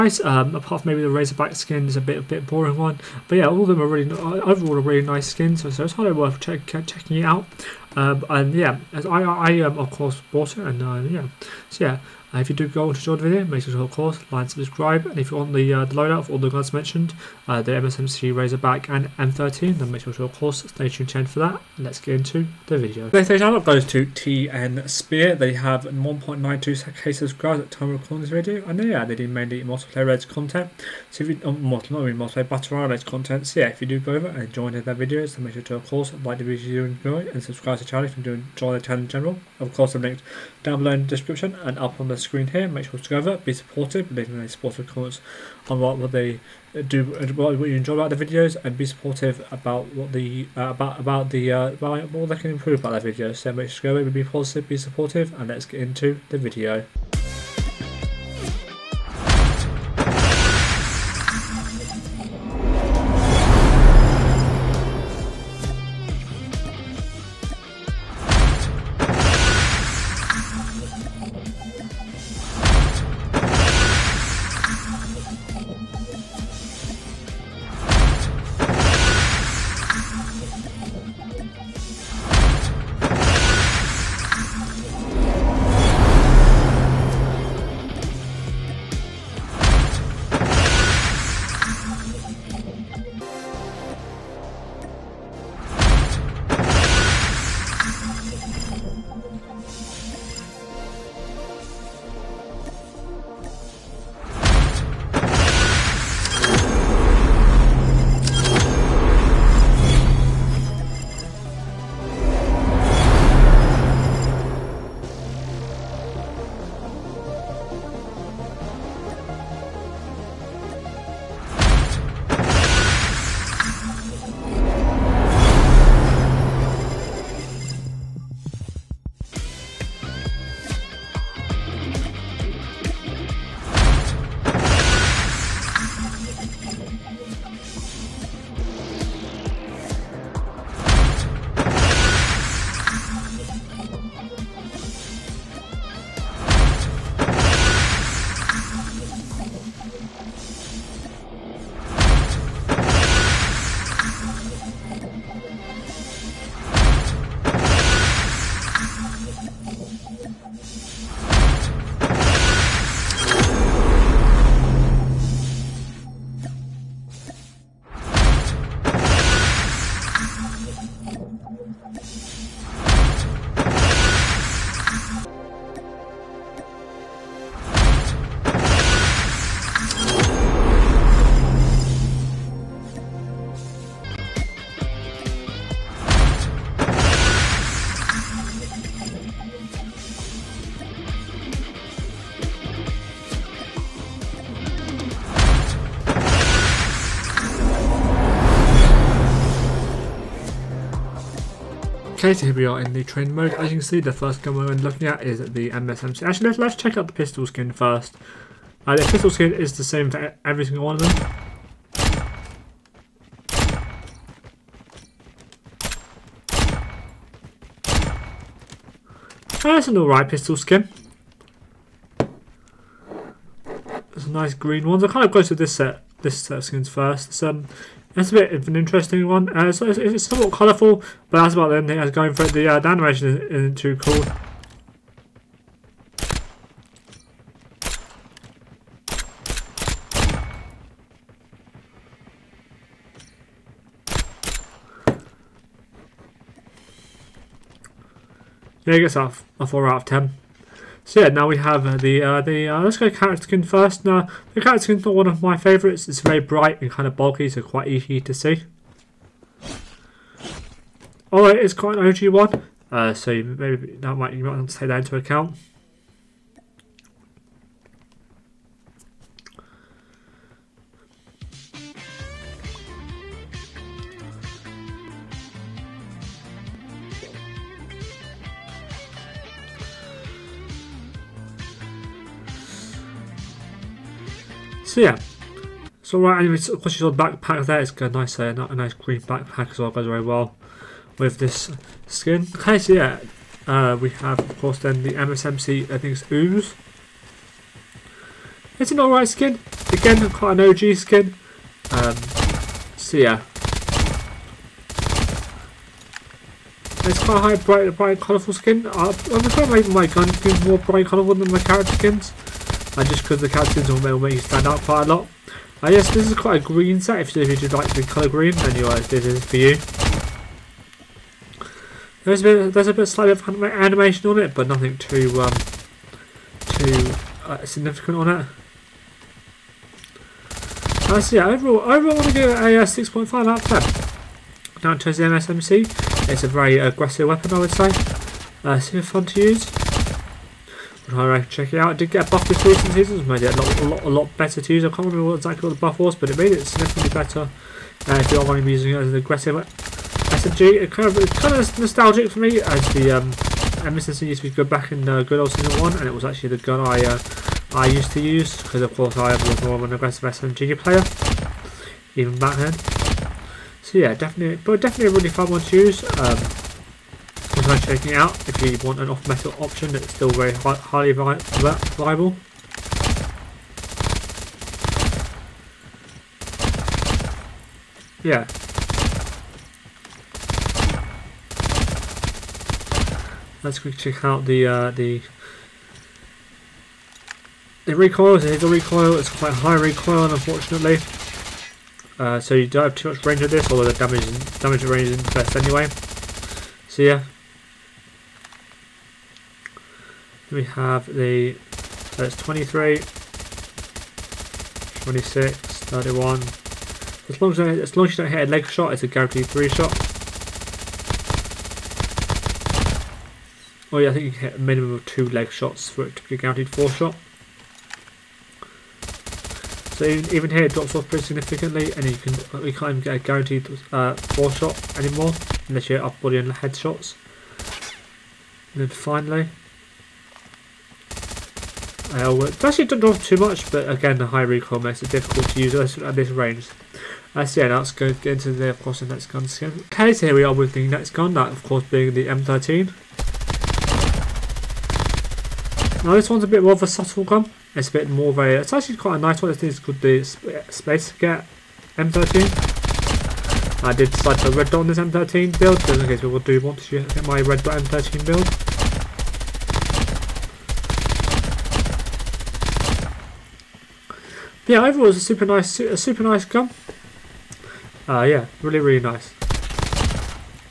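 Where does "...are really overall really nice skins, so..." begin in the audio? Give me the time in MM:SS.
00:03.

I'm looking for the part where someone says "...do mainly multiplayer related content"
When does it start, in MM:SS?
00:29.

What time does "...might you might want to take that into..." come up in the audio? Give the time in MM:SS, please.
04:24.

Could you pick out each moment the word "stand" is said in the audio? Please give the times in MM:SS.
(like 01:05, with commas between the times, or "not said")
05:14.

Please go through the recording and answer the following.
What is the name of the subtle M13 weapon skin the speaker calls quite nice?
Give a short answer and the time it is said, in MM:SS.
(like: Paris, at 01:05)
Space Cat M13, at 07:30.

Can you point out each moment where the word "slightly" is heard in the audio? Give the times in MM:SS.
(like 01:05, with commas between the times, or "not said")
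05:23.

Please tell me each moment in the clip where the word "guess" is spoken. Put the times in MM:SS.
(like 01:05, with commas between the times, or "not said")
05:15.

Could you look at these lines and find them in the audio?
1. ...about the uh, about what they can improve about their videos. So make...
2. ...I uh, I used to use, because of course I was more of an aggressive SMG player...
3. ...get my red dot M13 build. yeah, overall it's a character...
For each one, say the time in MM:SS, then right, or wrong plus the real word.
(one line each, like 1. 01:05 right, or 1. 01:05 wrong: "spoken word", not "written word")
1. 00:50 right
2. 05:56 right
3. 07:37 wrong: "super", not "character".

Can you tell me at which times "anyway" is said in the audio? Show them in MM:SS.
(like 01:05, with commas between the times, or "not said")
04:46, 06:35.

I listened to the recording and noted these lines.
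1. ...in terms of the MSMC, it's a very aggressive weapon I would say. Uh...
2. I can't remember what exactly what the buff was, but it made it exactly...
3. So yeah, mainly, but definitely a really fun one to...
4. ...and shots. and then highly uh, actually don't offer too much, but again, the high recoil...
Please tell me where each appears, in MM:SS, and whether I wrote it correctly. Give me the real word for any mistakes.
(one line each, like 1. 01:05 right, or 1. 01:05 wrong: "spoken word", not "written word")
1. 05:34 right
2. 05:44 wrong: "significantly", not "exactly"
3. 06:03 wrong: "definitely", not "mainly"
4. 07:06 wrong: "finally", not "highly".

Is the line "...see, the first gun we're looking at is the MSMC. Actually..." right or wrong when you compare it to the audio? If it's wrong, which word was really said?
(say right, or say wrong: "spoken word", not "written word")
right.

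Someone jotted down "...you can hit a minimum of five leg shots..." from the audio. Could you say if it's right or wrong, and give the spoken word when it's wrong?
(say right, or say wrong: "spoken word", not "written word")
wrong: "two", not "five".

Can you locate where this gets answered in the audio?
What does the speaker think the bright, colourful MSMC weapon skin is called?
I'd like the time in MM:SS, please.
04:56.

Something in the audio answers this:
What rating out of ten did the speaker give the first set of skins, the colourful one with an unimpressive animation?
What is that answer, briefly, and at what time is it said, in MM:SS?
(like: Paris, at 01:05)
4 out of 10, at 04:09.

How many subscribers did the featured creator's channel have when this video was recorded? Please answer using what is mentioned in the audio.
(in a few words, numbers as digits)
1.92k.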